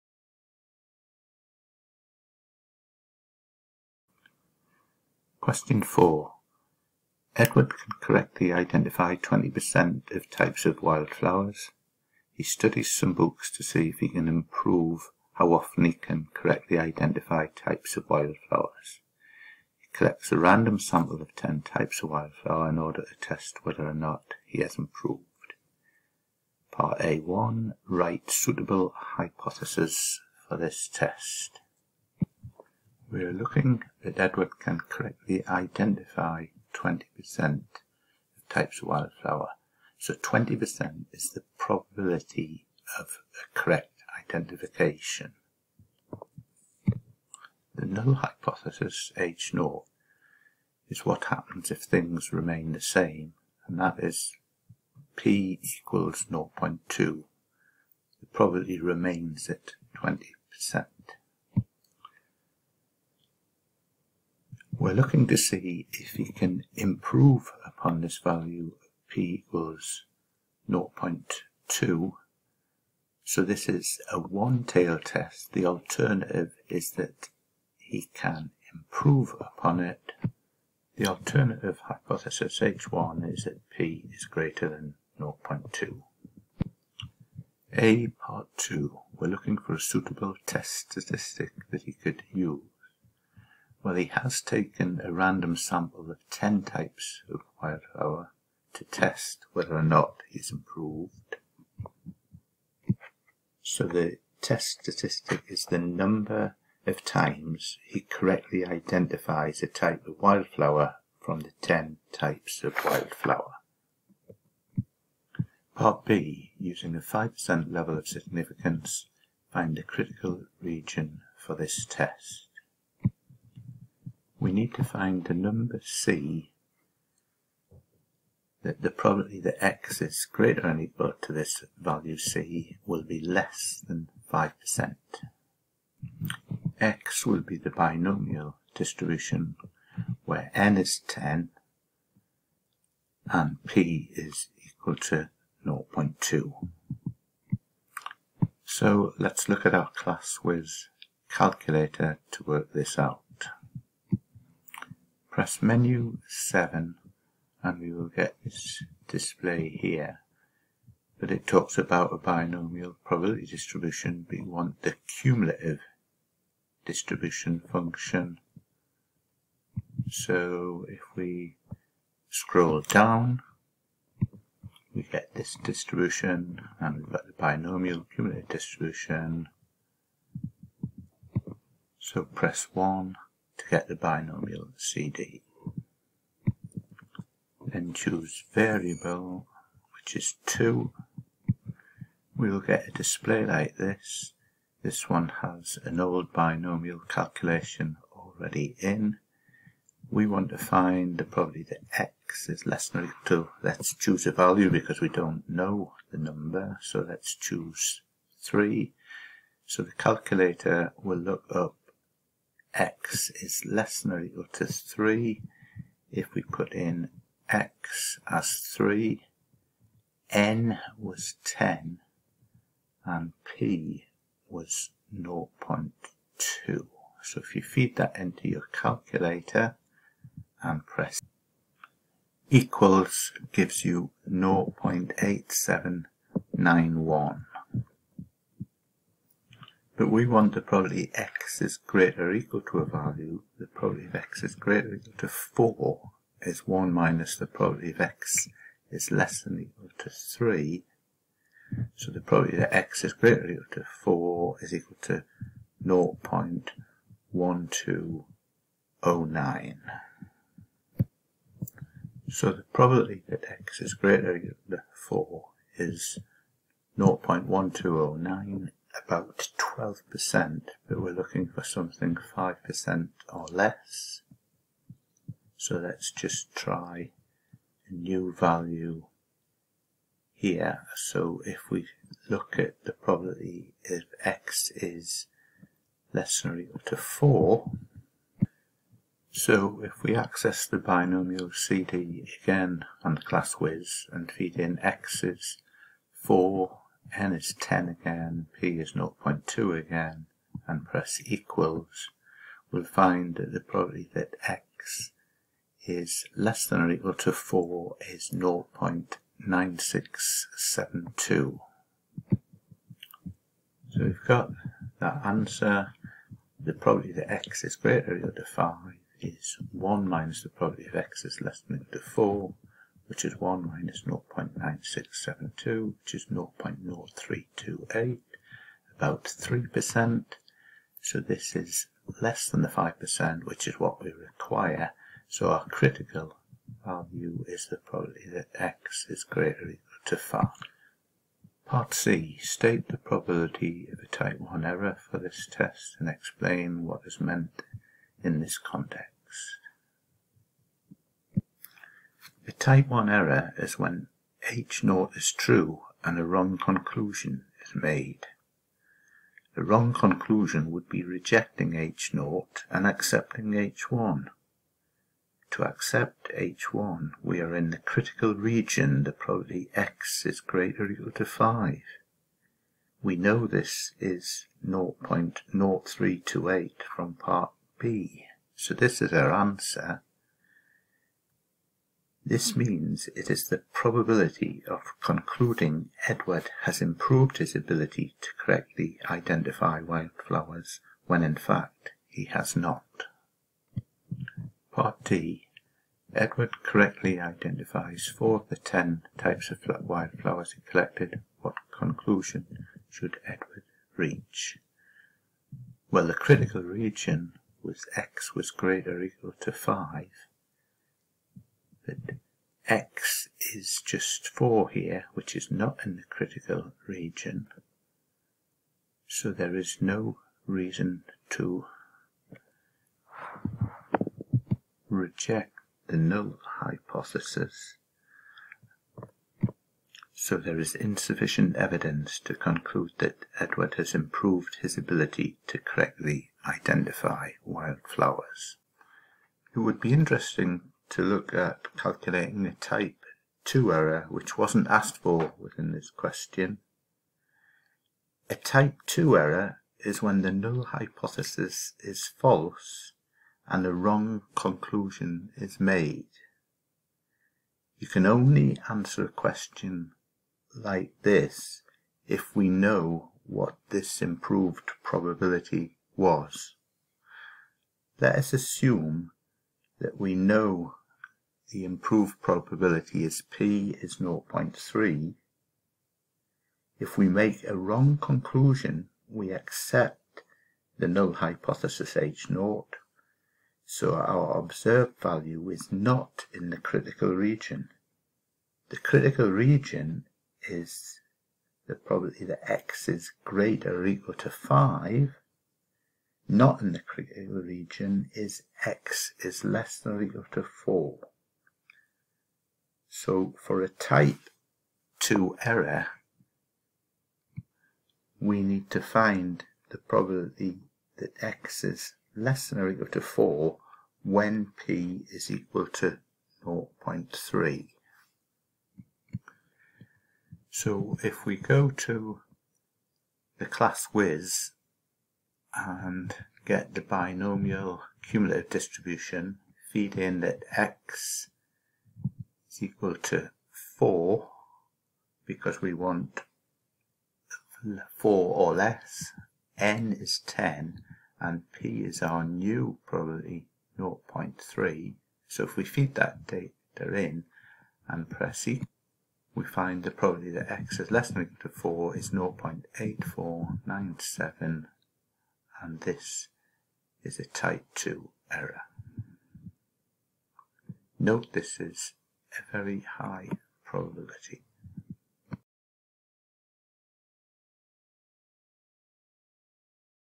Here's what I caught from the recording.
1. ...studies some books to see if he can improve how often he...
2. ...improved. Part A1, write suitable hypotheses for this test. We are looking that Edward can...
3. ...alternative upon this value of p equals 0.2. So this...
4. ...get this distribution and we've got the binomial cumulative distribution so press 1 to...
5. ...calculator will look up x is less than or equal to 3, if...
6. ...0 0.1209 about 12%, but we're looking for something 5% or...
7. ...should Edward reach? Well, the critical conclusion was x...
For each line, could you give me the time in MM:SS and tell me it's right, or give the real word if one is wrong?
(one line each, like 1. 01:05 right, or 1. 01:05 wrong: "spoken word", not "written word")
1. 00:12 right
2. 00:24 right
3. 01:06 wrong: "improve", not "alternative"
4. 02:55 right
5. 03:29 right
6. 04:26 right
7. 06:42 wrong: "region", not "conclusion".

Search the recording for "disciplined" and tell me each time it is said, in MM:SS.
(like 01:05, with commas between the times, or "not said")
not said.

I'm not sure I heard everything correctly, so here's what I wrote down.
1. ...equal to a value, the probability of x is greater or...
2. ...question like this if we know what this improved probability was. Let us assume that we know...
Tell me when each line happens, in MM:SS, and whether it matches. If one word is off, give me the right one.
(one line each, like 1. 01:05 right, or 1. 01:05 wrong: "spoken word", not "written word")
1. 04:02 right
2. 07:39 right.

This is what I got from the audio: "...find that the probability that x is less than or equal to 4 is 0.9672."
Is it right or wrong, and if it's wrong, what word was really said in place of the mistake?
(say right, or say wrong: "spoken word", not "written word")
right.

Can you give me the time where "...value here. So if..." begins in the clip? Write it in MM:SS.
04:38.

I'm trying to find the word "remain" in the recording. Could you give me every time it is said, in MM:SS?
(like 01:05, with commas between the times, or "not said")
00:52, 00:58.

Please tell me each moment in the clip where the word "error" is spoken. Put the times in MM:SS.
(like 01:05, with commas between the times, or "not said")
05:44, 05:53, 07:23, 07:29, 08:25, 09:18.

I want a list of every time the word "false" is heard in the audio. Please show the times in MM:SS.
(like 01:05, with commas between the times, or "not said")
07:32.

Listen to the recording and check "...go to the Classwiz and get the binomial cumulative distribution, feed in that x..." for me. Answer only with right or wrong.
right.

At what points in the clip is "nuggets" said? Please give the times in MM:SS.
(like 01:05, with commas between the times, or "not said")
not said.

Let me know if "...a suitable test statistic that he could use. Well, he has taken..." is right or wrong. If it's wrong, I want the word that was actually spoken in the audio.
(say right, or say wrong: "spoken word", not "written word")
right.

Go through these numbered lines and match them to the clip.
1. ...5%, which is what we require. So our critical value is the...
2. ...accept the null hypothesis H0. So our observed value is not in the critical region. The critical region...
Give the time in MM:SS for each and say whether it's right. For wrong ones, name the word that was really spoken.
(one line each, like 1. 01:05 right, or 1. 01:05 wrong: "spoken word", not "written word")
1. 05:32 right
2. 07:59 right.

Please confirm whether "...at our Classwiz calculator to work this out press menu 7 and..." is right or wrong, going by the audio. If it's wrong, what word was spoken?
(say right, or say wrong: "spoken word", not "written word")
right.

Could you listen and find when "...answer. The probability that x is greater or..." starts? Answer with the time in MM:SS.
05:15.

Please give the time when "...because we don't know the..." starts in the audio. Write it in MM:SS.
03:24.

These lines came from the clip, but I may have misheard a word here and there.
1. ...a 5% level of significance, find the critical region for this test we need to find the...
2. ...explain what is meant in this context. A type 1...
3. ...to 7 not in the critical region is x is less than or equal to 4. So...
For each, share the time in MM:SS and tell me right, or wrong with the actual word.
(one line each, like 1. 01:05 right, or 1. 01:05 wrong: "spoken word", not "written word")
1. 01:56 right
2. 05:46 right
3. 08:14 wrong: "5", not "7".